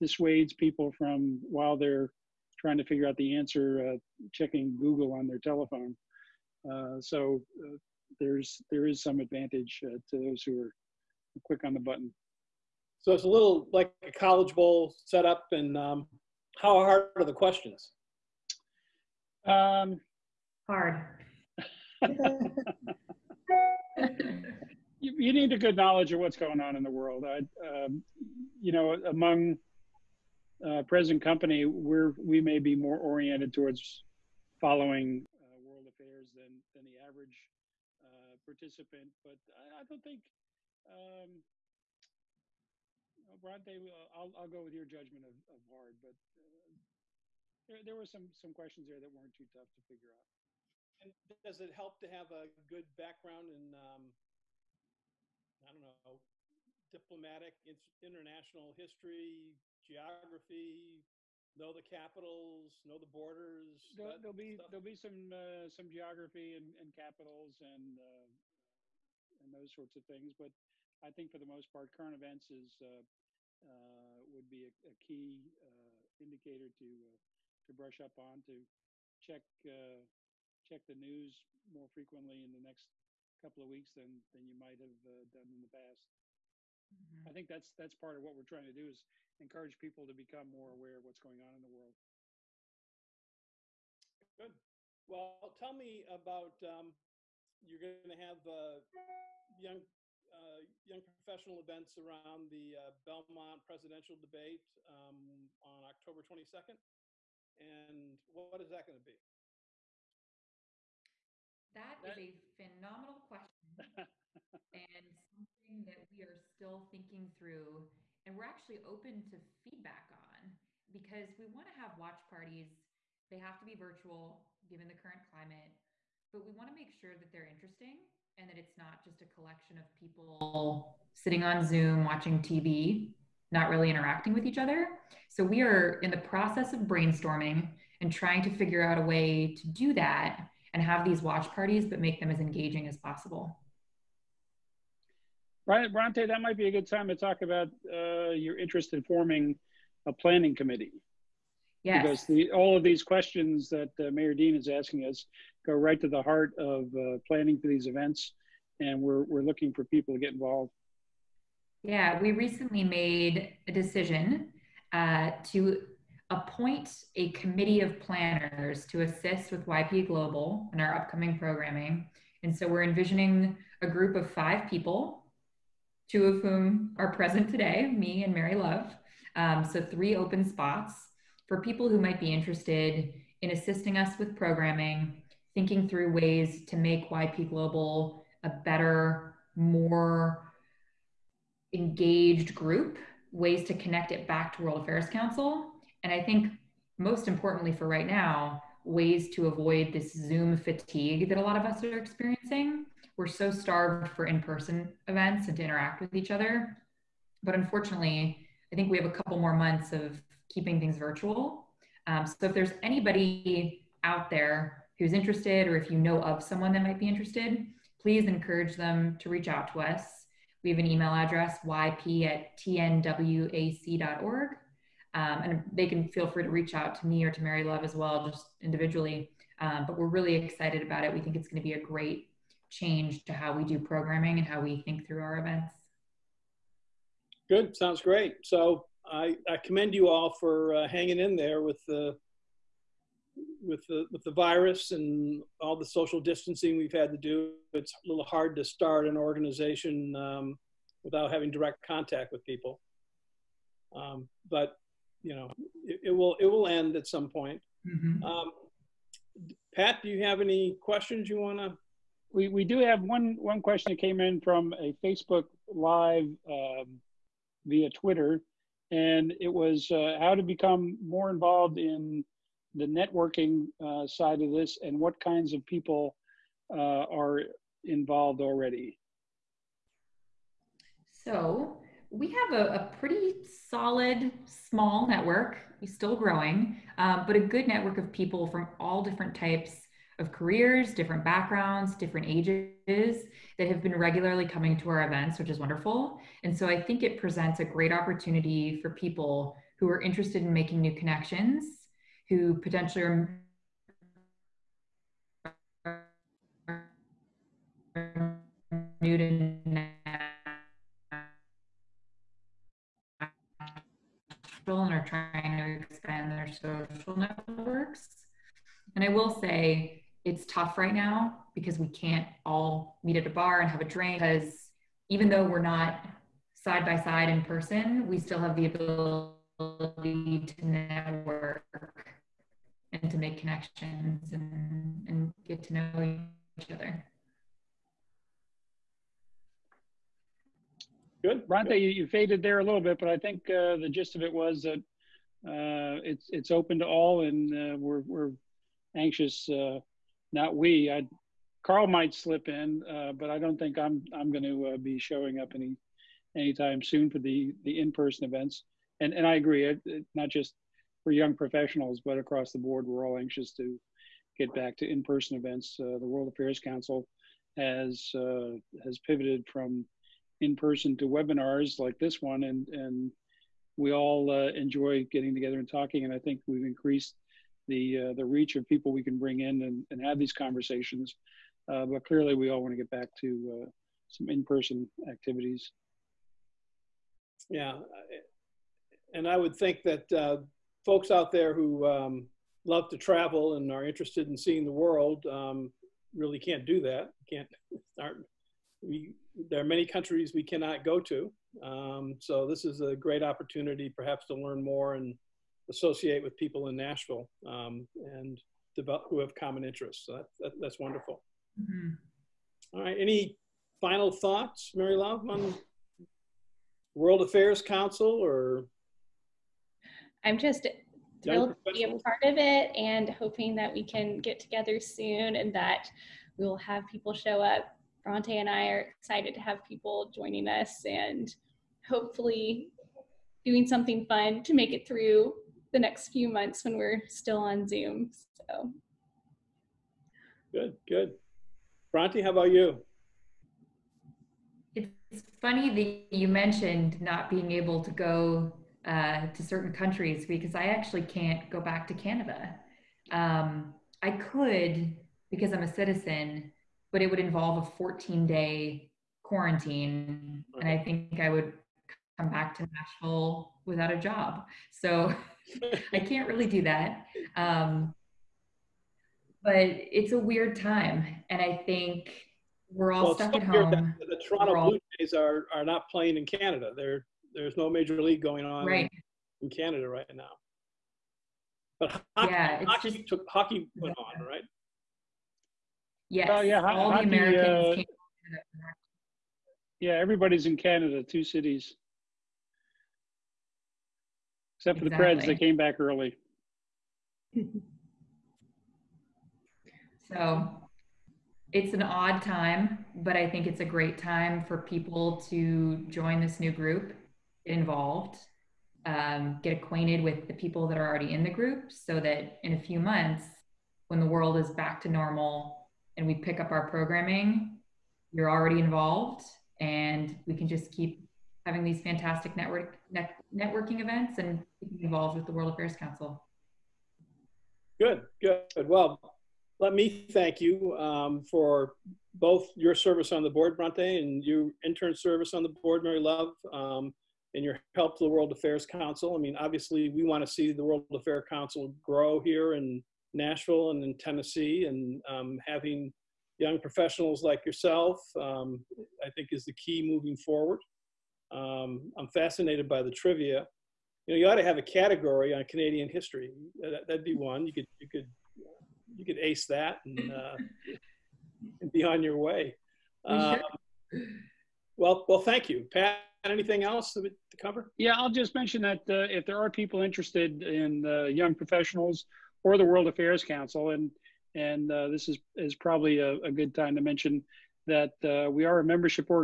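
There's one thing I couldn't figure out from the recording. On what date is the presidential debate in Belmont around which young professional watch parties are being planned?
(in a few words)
October 22nd.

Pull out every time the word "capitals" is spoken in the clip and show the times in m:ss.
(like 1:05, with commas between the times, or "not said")
1:01, 1:06.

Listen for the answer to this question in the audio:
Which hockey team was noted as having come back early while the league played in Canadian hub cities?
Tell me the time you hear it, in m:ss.
8:15.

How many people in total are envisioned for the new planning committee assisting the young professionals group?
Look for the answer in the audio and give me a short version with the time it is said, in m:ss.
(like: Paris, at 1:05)
5, at 2:54.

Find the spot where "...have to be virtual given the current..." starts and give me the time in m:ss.
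2:03.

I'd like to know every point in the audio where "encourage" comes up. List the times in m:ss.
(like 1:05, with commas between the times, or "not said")
1:29, 3:38.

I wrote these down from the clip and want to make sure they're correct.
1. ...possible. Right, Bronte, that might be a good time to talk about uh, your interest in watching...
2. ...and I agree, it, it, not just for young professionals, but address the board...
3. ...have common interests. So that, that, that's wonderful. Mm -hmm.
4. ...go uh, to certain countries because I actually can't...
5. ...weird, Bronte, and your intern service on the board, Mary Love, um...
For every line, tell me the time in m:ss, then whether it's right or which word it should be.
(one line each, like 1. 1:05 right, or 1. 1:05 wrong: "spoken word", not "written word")
1. 2:22 wrong: "forming", not "watching"
2. 5:59 wrong: "across", not "address"
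3. 6:49 right
4. 7:27 right
5. 8:53 wrong: "board", not "weird".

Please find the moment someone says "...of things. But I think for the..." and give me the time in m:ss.
1:09.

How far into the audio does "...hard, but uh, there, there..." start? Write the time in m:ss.
0:45.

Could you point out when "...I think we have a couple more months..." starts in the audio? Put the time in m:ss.
3:28.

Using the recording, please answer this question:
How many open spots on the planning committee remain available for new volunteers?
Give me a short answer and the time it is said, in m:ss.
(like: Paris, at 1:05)
3, at 2:59.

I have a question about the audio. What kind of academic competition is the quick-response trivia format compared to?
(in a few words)
College bowl.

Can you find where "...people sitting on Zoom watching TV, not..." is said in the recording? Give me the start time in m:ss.
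2:09.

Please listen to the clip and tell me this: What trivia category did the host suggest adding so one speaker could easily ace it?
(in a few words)
Canadian history.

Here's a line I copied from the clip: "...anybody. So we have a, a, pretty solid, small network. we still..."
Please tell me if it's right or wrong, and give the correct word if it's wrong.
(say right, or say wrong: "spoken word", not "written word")
wrong: "already", not "anybody".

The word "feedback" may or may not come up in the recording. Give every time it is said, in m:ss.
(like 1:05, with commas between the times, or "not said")
1:59.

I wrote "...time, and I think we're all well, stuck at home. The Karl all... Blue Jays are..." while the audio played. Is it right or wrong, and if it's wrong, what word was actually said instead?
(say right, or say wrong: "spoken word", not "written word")
wrong: "Toronto", not "Karl".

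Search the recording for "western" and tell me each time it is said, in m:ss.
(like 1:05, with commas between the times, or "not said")
not said.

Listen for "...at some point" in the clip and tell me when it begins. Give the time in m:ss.
4:16.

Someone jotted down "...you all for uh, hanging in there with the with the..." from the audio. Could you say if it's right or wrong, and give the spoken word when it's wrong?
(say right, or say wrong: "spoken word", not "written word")
right.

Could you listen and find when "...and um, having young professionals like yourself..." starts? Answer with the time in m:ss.
9:04.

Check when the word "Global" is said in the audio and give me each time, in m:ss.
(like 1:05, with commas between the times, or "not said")
2:50, 3:07.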